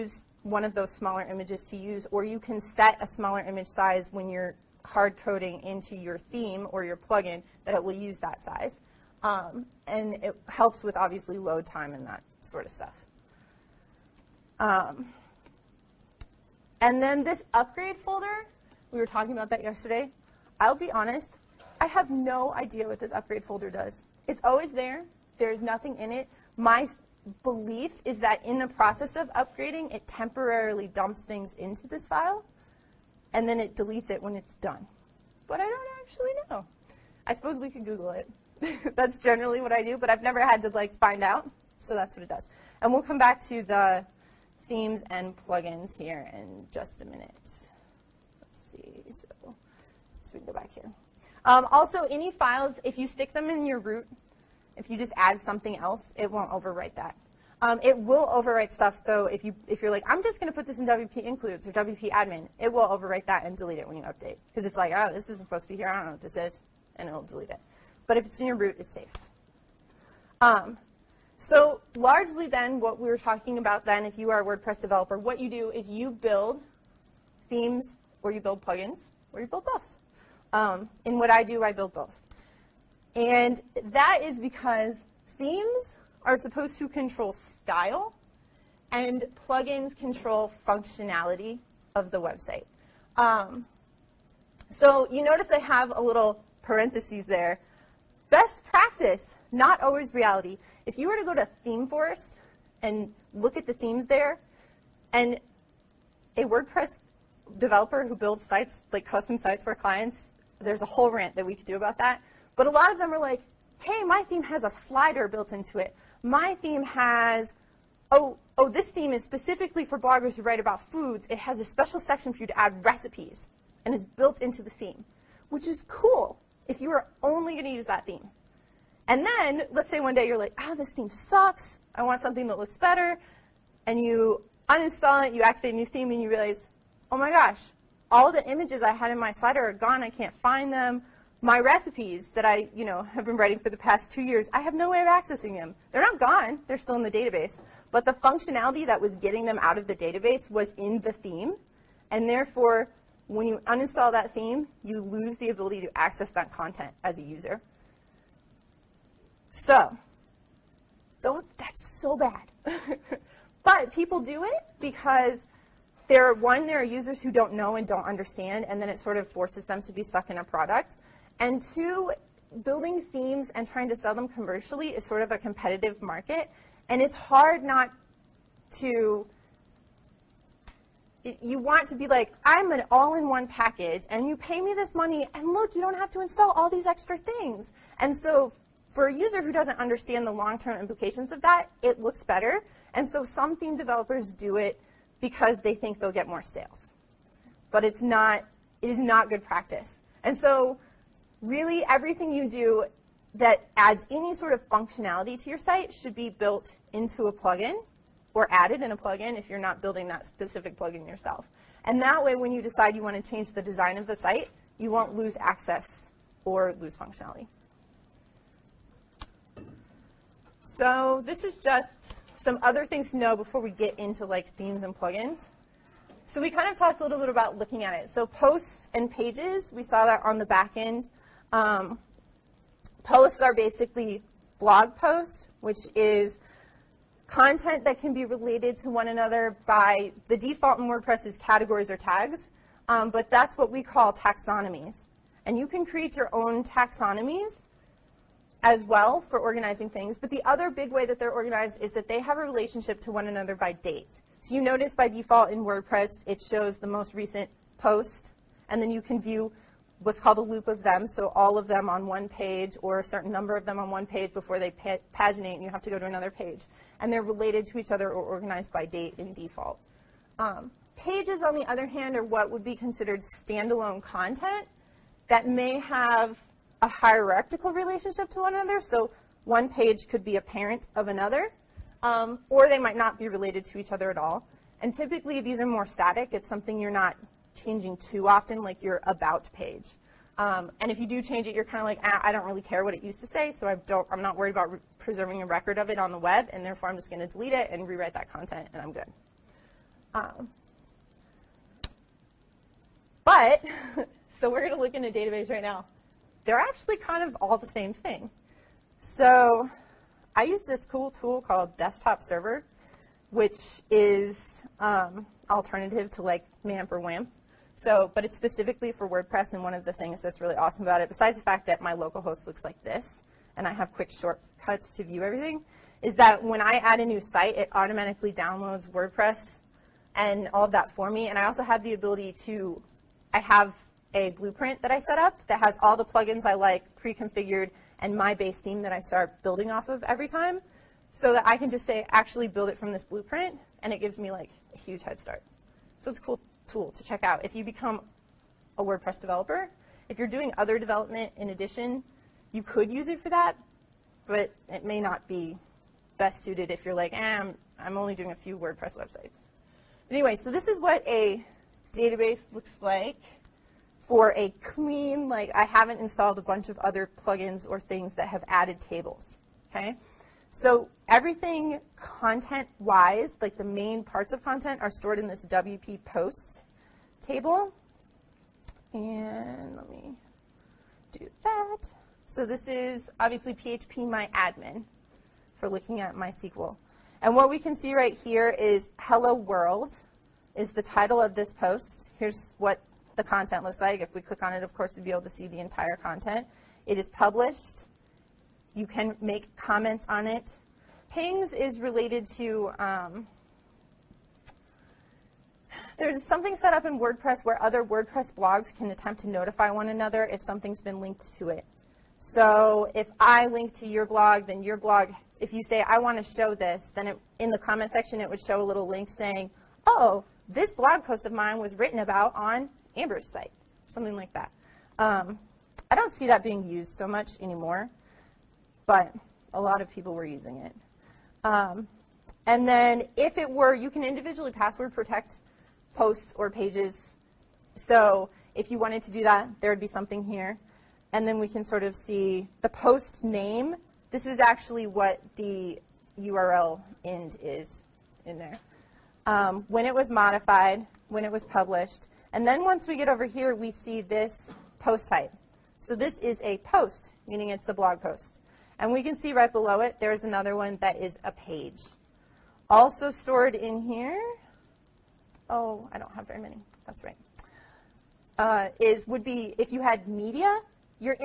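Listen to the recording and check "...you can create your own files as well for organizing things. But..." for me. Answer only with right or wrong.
wrong.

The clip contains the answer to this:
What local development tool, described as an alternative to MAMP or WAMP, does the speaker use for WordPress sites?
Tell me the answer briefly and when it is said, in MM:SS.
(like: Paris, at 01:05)
Desktop Server, at 05:11.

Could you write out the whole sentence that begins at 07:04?
Um, I don't see that being used so much anymore but a lot of people were using it.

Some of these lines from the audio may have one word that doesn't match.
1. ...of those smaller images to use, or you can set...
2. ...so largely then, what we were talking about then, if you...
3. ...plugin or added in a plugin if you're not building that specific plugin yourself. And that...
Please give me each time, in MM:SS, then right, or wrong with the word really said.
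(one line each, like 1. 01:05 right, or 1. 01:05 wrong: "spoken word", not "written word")
1. 00:00 right
2. 01:11 right
3. 03:27 right.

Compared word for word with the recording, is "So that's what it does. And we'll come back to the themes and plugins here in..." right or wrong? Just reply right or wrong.
right.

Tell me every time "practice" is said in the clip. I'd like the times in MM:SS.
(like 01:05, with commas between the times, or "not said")
01:38, 03:19.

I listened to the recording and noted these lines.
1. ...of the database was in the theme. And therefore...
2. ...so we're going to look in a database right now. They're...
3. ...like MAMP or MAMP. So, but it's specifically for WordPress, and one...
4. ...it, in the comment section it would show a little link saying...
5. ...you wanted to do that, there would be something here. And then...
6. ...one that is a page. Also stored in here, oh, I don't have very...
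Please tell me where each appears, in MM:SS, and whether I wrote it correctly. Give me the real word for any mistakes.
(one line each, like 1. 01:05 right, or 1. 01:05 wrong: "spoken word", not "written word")
1. 02:29 right
2. 05:04 right
3. 05:16 wrong: "WAMP", not "MAMP"
4. 06:57 right
5. 07:18 right
6. 07:40 right.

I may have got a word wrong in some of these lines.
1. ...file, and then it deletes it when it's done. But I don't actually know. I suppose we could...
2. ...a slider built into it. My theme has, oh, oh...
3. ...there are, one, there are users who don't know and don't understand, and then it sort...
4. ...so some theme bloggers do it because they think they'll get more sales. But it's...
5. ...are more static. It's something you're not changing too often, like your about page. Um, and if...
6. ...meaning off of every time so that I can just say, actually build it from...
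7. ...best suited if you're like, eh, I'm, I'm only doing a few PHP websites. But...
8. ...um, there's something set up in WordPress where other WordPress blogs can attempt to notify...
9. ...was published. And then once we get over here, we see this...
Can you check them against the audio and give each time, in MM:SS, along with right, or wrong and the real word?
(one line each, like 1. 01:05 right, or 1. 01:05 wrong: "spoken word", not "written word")
1. 00:32 right
2. 01:54 right
3. 02:46 right
4. 03:13 wrong: "developers", not "bloggers"
5. 04:45 right
6. 05:39 wrong: "building", not "meaning"
7. 05:56 wrong: "WordPress", not "PHP"
8. 06:42 right
9. 07:31 right.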